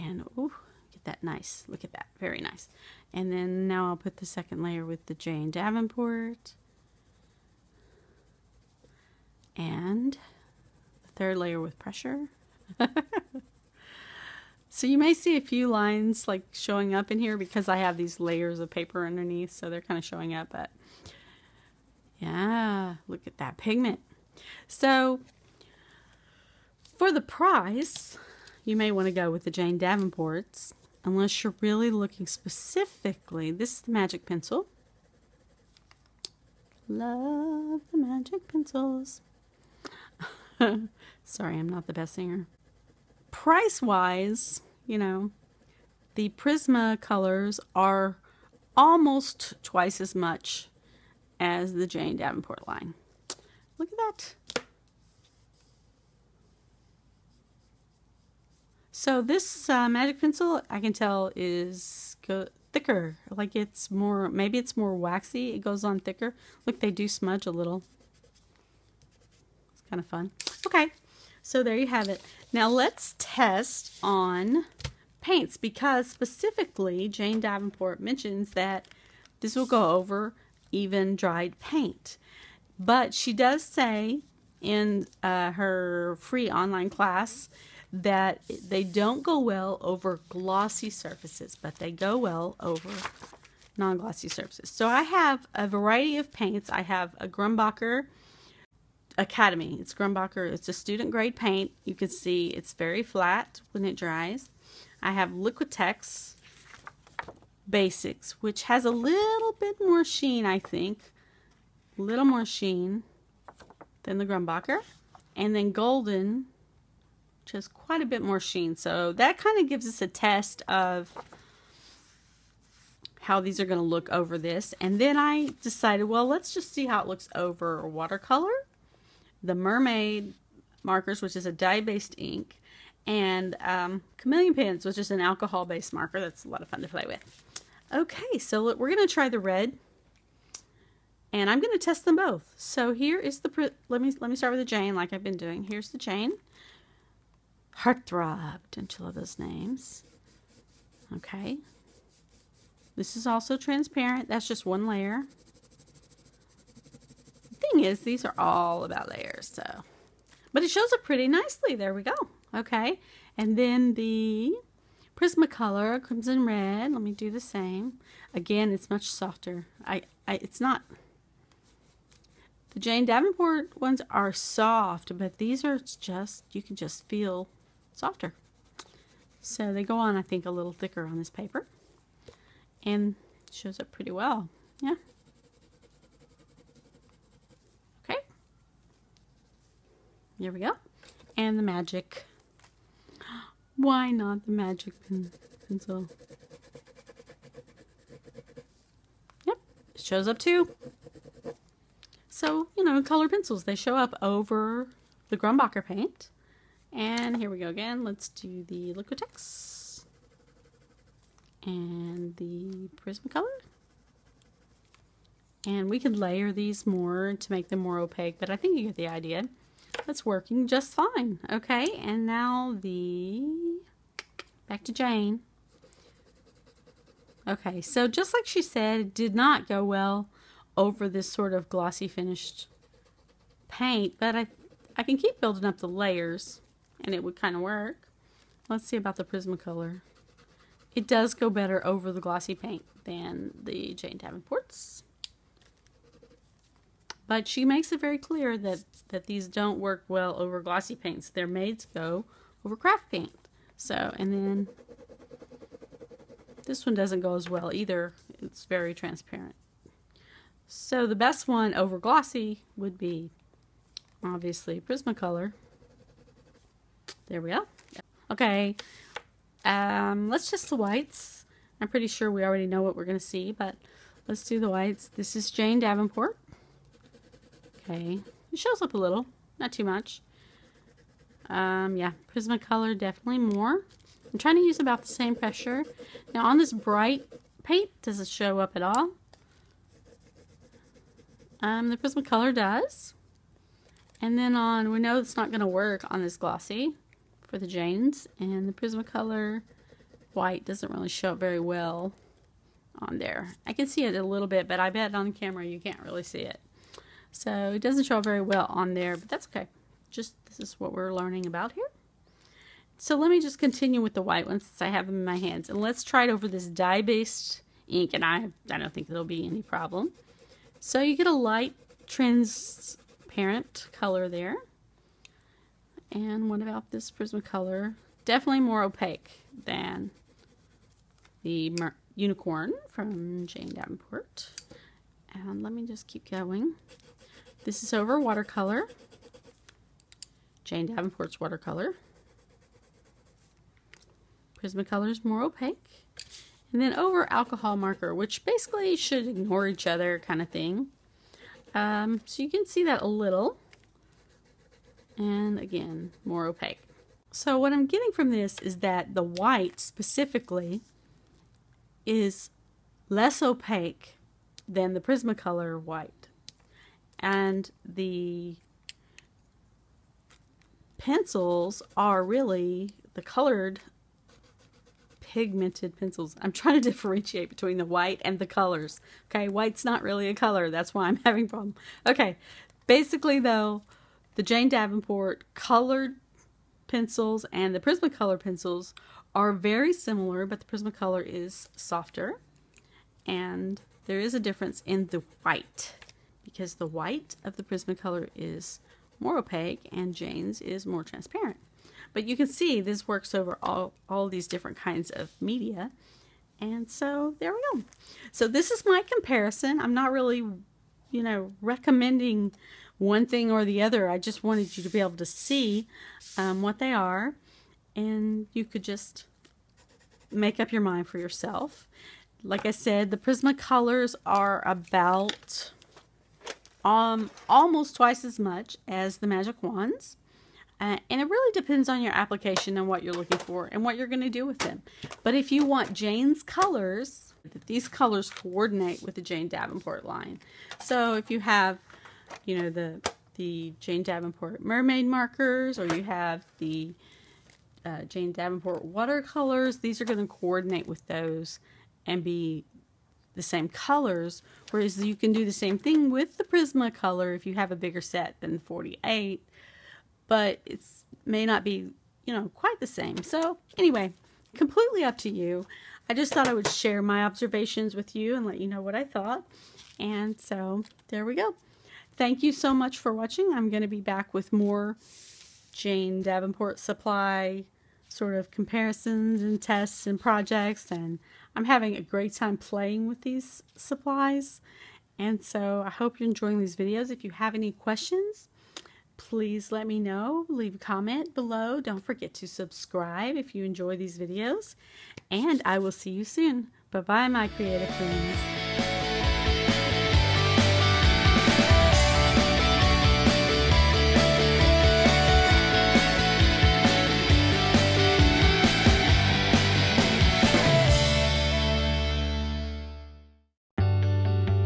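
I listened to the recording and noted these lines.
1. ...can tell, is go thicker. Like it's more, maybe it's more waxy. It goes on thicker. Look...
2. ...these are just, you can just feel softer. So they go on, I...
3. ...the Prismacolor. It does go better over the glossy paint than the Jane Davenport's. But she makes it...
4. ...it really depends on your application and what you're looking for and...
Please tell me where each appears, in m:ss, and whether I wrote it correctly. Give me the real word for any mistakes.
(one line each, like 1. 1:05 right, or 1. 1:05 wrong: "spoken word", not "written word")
1. 1:00 right
2. 2:55 right
3. 3:59 right
4. 7:11 right.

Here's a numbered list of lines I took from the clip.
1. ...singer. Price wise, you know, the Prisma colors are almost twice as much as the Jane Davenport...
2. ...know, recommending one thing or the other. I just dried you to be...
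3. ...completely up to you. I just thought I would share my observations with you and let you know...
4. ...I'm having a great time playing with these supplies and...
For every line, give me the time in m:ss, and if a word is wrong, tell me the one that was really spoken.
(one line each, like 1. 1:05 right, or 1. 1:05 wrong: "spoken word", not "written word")
1. 0:42 right
2. 6:51 wrong: "wanted", not "dried"
3. 7:44 right
4. 8:01 right.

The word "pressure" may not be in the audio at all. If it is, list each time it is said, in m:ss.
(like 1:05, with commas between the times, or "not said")
0:11, 4:45.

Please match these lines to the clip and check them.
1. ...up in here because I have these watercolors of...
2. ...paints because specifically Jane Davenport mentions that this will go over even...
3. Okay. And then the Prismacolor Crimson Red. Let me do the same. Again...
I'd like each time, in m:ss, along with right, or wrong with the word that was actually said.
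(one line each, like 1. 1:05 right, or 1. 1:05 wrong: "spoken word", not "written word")
1. 0:16 wrong: "layers", not "watercolors"
2. 1:15 right
3. 2:42 right.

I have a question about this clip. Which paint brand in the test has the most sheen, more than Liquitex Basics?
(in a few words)
Golden.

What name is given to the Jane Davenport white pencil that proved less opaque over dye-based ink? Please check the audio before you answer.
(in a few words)
Mer Unicorn.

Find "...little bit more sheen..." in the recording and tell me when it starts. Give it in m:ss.
1:48.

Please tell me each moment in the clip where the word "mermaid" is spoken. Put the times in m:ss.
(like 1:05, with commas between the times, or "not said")
2:09, 7:24.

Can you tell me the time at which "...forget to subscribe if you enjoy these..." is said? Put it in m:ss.
8:12.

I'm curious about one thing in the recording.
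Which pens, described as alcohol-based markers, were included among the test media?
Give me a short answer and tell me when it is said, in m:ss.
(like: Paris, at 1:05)
Chameleon pens, at 2:14.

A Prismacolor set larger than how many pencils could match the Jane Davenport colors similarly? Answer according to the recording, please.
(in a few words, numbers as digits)
48.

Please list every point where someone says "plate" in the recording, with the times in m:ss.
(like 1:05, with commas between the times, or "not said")
not said.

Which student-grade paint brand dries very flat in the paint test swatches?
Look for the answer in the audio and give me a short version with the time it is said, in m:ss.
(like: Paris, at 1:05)
Grumbacher Academy, at 1:37.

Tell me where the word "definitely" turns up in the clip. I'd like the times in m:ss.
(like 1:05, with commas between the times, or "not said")
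4:42, 5:28.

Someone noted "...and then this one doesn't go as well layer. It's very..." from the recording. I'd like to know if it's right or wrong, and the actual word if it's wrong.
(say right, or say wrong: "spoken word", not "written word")
wrong: "either", not "layer".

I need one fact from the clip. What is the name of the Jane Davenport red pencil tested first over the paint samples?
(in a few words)
Heartthrob.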